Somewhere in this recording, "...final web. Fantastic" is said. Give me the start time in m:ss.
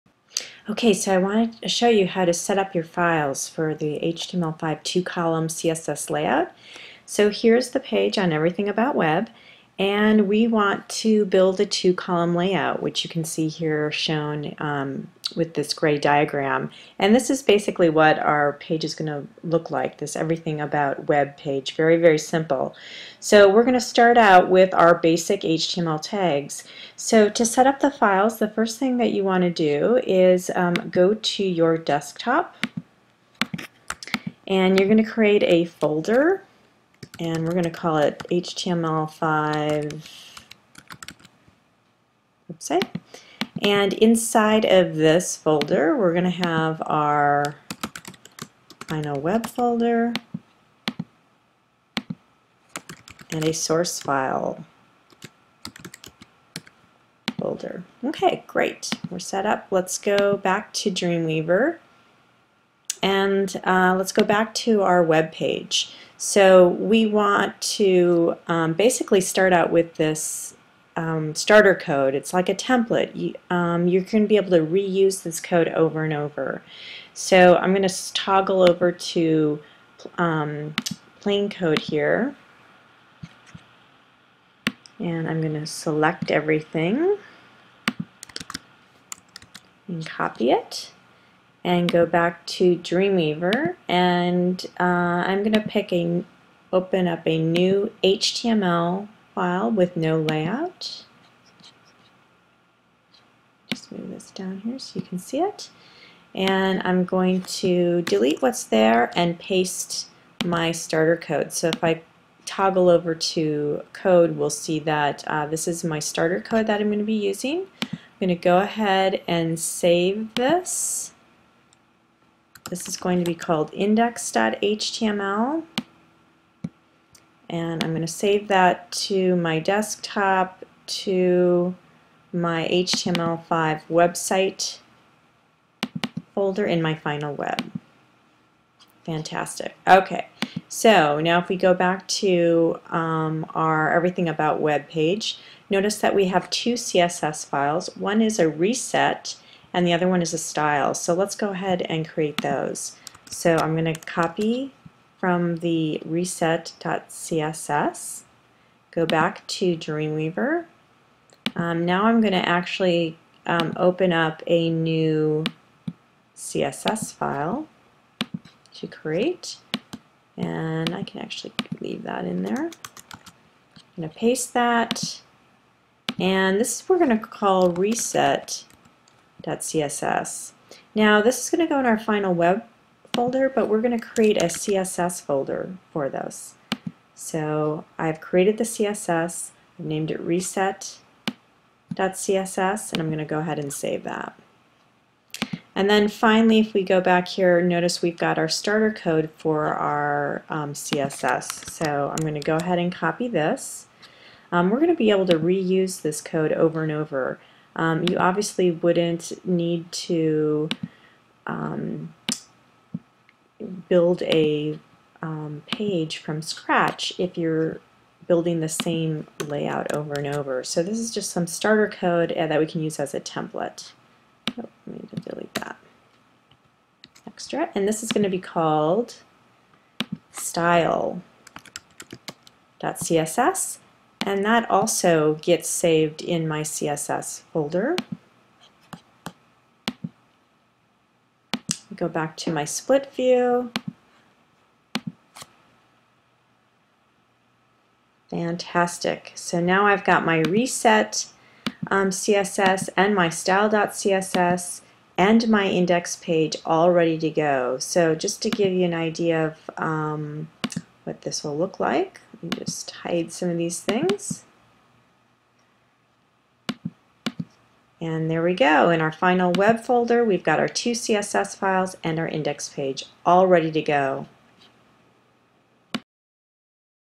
2:16.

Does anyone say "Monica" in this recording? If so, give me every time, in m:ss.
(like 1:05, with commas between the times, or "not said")
not said.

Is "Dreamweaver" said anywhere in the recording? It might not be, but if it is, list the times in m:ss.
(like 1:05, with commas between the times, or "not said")
1:00, 1:32, 2:39.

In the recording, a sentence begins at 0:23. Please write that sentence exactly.
So we're going to start out with our basic HTML tags.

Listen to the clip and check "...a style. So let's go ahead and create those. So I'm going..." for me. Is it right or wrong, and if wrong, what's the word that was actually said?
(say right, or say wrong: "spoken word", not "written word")
right.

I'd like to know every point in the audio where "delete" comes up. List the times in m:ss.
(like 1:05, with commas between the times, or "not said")
1:48, 3:45.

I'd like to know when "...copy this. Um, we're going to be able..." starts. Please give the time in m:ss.
3:22.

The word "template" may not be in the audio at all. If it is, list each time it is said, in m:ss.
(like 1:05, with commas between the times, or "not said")
1:12, 3:43.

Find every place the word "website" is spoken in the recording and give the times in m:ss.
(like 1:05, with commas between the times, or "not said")
0:42, 2:13.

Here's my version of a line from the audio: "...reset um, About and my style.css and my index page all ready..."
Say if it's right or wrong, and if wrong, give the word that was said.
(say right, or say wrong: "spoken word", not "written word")
wrong: "CSS", not "About".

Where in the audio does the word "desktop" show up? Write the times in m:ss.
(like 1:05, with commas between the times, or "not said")
0:31, 2:09.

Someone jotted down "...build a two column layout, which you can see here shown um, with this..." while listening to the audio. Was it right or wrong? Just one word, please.
right.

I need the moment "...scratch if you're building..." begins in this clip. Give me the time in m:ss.
3:36.